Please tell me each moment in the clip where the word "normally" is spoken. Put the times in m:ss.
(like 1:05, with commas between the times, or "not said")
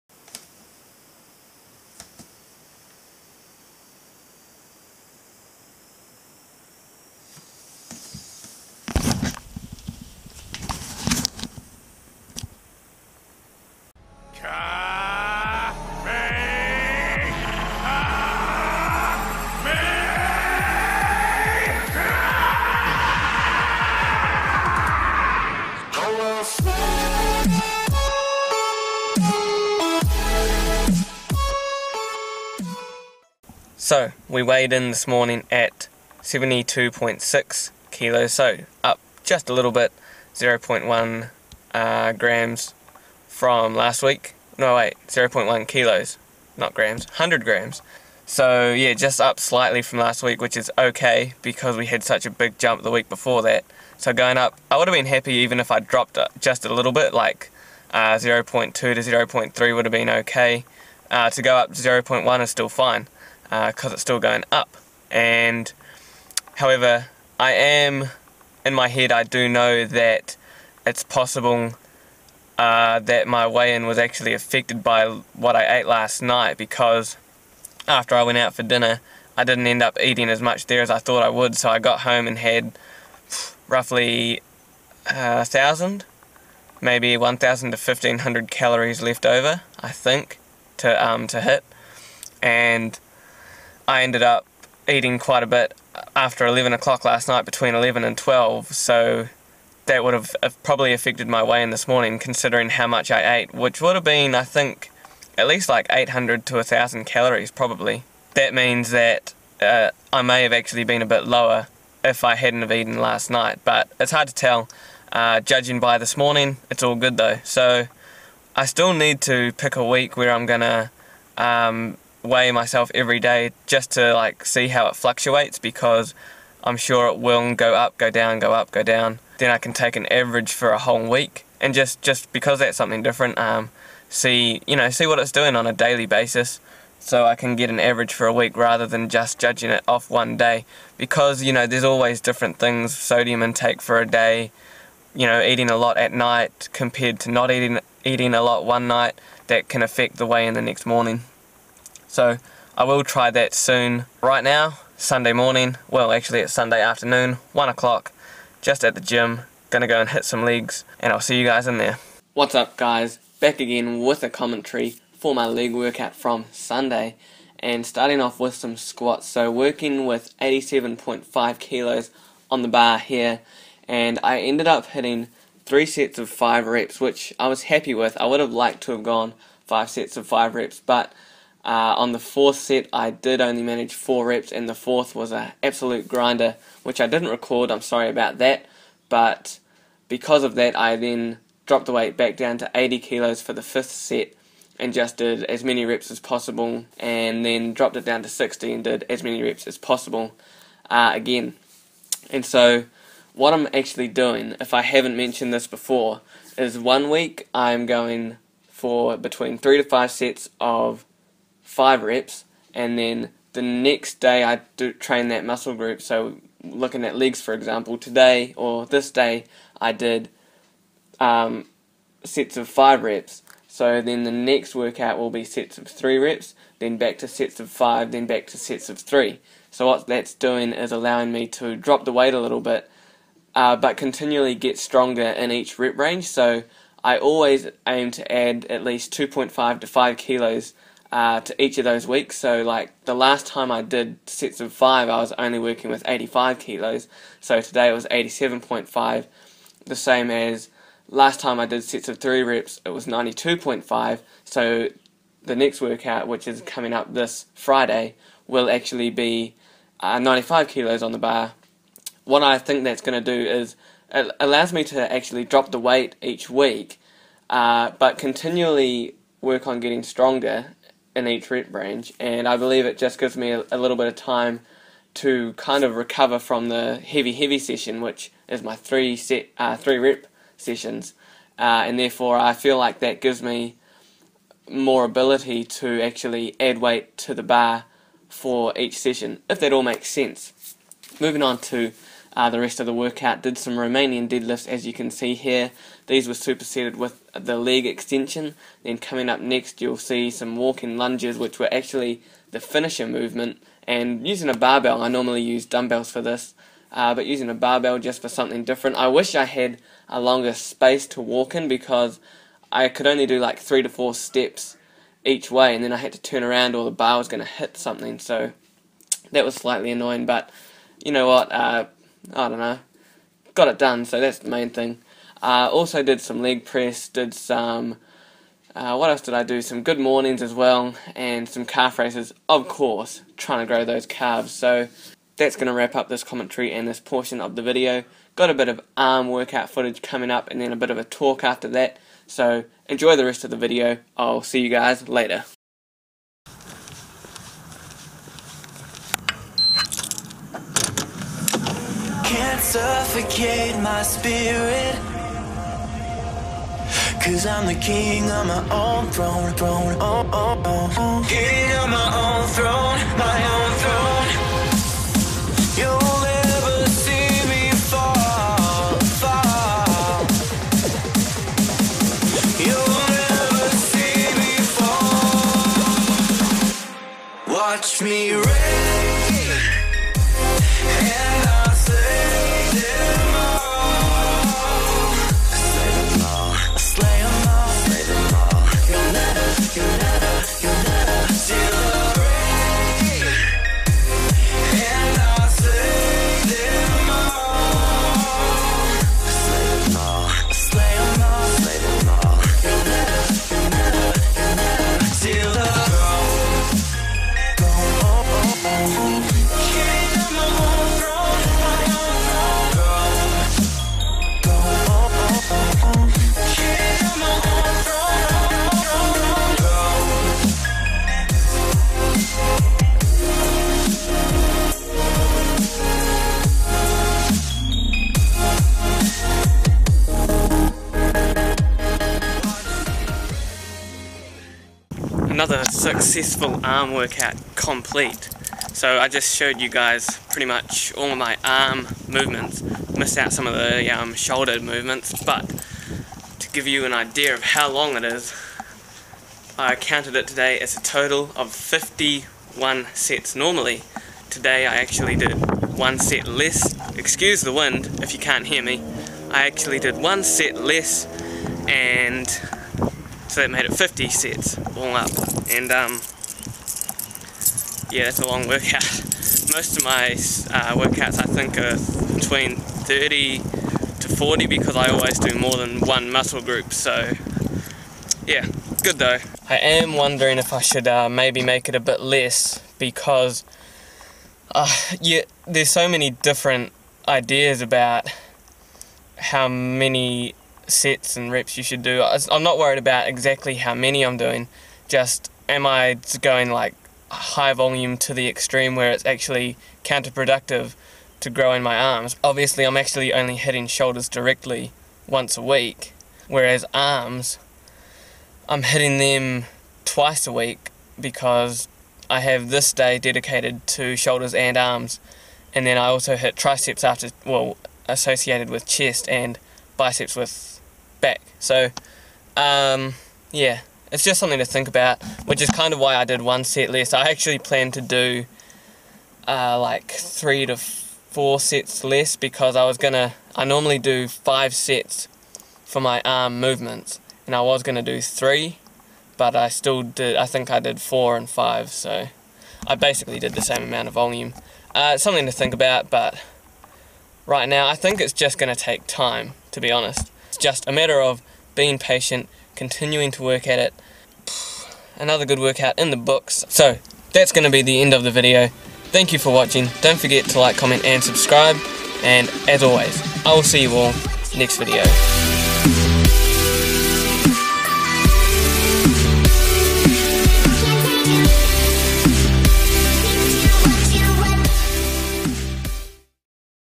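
5:05, 7:33, 8:53.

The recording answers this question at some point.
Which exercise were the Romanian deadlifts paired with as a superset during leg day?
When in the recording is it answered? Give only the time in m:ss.
4:57.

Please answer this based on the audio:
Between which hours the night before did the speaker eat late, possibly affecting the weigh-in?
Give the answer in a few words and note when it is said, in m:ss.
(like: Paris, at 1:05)
11 and 12, at 1:37.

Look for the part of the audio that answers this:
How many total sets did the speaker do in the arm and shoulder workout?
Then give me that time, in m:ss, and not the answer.
7:43.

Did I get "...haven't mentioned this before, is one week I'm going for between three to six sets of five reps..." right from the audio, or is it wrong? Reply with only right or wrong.
wrong.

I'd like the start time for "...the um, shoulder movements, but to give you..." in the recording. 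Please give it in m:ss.
7:23.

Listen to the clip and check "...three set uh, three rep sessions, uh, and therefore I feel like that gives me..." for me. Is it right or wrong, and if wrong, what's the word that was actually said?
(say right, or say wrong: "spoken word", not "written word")
right.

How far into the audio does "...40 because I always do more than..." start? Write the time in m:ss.
7:54.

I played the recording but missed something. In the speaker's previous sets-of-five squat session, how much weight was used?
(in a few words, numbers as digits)
85 kilos.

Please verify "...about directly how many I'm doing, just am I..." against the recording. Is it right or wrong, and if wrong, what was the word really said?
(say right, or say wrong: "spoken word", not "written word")
wrong: "exactly", not "directly".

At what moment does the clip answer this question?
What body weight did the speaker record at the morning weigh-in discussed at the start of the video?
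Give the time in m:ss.
0:36.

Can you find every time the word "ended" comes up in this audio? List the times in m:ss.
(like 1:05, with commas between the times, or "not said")
1:34, 2:54.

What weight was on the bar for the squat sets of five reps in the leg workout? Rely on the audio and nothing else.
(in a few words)
87.5 kilos.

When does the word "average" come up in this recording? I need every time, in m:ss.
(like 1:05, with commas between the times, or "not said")
2:10, 2:17.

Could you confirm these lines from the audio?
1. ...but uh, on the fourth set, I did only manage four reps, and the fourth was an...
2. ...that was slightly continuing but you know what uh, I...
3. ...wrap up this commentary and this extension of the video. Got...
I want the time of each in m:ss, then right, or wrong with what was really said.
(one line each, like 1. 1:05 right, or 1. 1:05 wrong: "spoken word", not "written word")
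1. 3:00 right
2. 5:19 wrong: "annoying", not "continuing"
3. 5:35 wrong: "portion", not "extension".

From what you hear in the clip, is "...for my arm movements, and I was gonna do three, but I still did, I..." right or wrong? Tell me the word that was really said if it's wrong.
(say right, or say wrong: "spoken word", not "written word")
right.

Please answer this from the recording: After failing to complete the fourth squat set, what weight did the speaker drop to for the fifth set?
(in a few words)
80 kilos.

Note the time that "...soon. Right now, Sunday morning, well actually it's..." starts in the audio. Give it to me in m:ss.
2:33.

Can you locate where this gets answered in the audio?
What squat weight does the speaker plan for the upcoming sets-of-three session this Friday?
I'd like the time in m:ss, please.
4:20.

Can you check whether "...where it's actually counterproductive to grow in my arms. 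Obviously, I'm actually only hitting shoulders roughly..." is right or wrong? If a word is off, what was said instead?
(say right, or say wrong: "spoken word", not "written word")
wrong: "directly", not "roughly".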